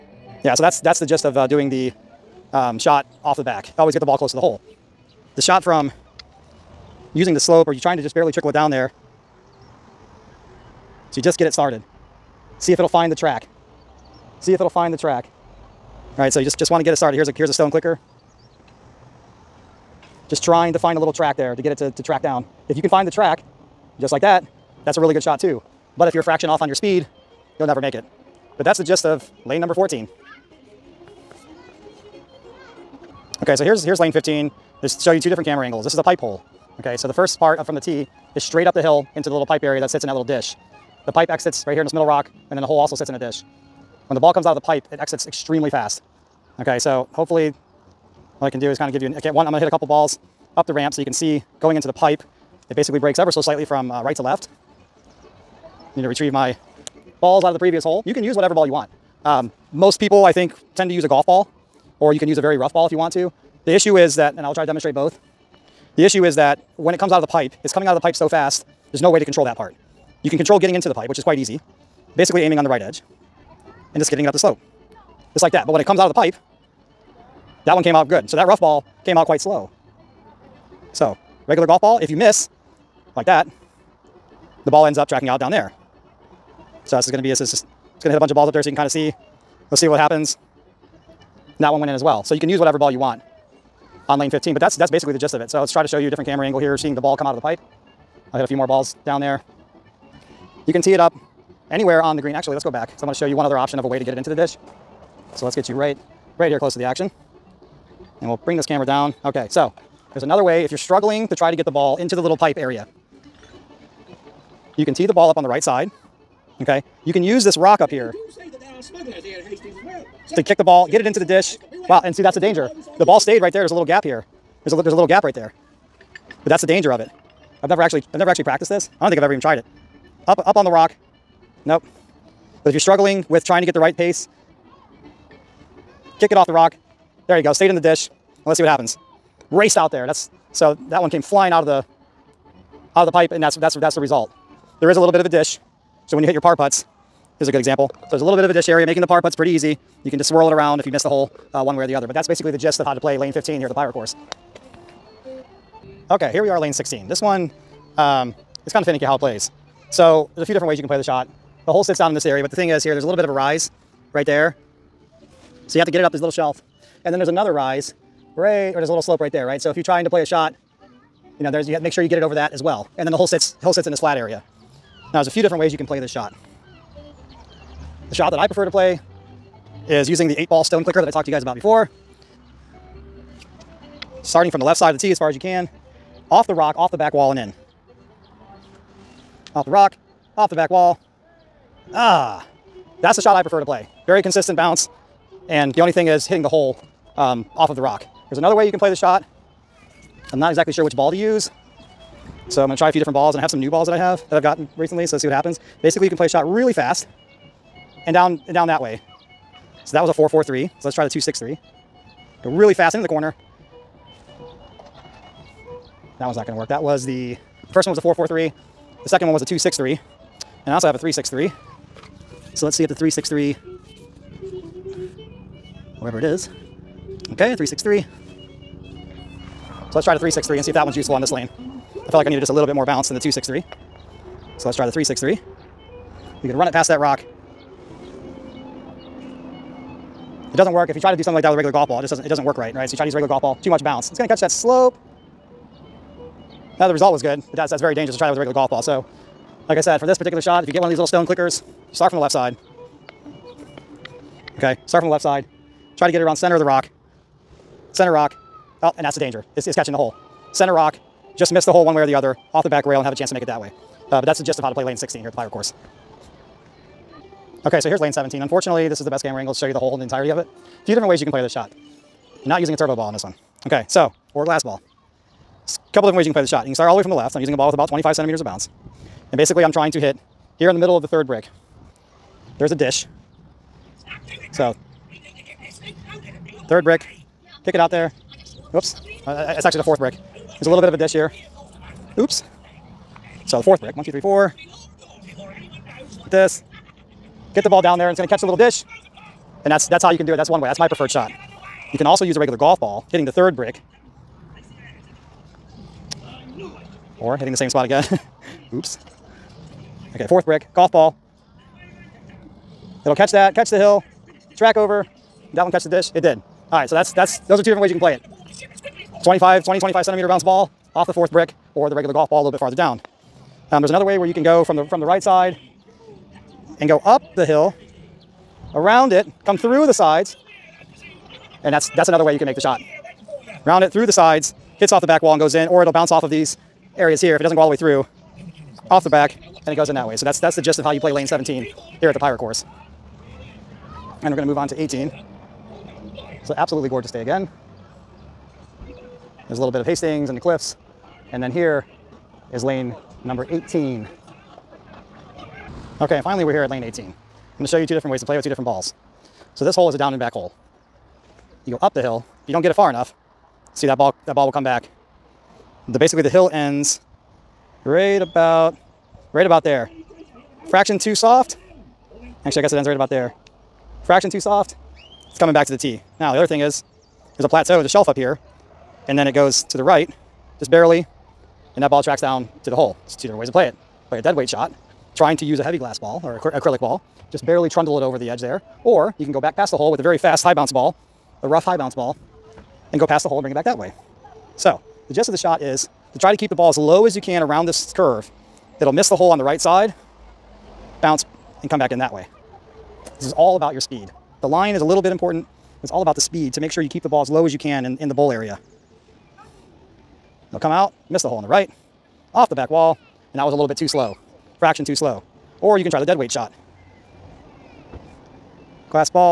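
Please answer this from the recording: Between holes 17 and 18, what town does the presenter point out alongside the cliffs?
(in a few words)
Hastings.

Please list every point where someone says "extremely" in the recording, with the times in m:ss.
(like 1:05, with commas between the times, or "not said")
0:45.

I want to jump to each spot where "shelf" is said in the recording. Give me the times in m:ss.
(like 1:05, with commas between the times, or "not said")
2:46, 6:17.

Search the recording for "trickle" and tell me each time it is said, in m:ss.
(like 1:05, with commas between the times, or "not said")
0:08.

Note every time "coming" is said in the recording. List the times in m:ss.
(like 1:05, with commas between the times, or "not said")
1:07, 6:15.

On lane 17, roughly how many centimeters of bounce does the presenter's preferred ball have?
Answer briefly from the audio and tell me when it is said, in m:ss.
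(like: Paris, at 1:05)
25, at 4:37.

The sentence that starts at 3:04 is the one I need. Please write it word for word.
Starting from the left side of the tee as far as you can, off the rock, off the back wall and in.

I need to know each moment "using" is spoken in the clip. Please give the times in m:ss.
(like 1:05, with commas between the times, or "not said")
0:07, 3:00, 4:32, 4:37.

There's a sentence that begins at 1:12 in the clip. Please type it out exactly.
Basically aiming on the right edge and just getting it up the slope.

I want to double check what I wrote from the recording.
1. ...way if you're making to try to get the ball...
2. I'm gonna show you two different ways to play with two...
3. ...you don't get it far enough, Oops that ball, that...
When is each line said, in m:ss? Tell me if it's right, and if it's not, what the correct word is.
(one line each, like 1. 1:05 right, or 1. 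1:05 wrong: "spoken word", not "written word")
1. 1:50 wrong: "struggling", not "making"
2. 5:57 right
3. 6:02 wrong: "See", not "Oops".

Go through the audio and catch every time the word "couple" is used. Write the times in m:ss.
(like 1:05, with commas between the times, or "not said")
0:49, 4:35.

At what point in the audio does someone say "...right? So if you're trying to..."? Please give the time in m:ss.
2:49.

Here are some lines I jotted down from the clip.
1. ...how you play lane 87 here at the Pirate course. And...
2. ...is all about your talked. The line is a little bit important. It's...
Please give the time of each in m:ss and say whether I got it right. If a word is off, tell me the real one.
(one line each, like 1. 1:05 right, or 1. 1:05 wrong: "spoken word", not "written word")
1. 5:40 wrong: "17", not "87"
2. 6:43 wrong: "speed", not "talked".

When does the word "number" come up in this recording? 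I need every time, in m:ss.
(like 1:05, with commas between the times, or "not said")
0:29, 5:53.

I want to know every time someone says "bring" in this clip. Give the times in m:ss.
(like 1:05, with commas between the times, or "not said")
1:48, 6:33.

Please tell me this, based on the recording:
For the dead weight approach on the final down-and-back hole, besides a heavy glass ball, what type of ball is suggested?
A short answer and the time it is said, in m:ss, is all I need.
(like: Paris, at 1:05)
acrylic ball, at 6:26.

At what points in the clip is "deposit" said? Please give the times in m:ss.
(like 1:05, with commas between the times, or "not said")
not said.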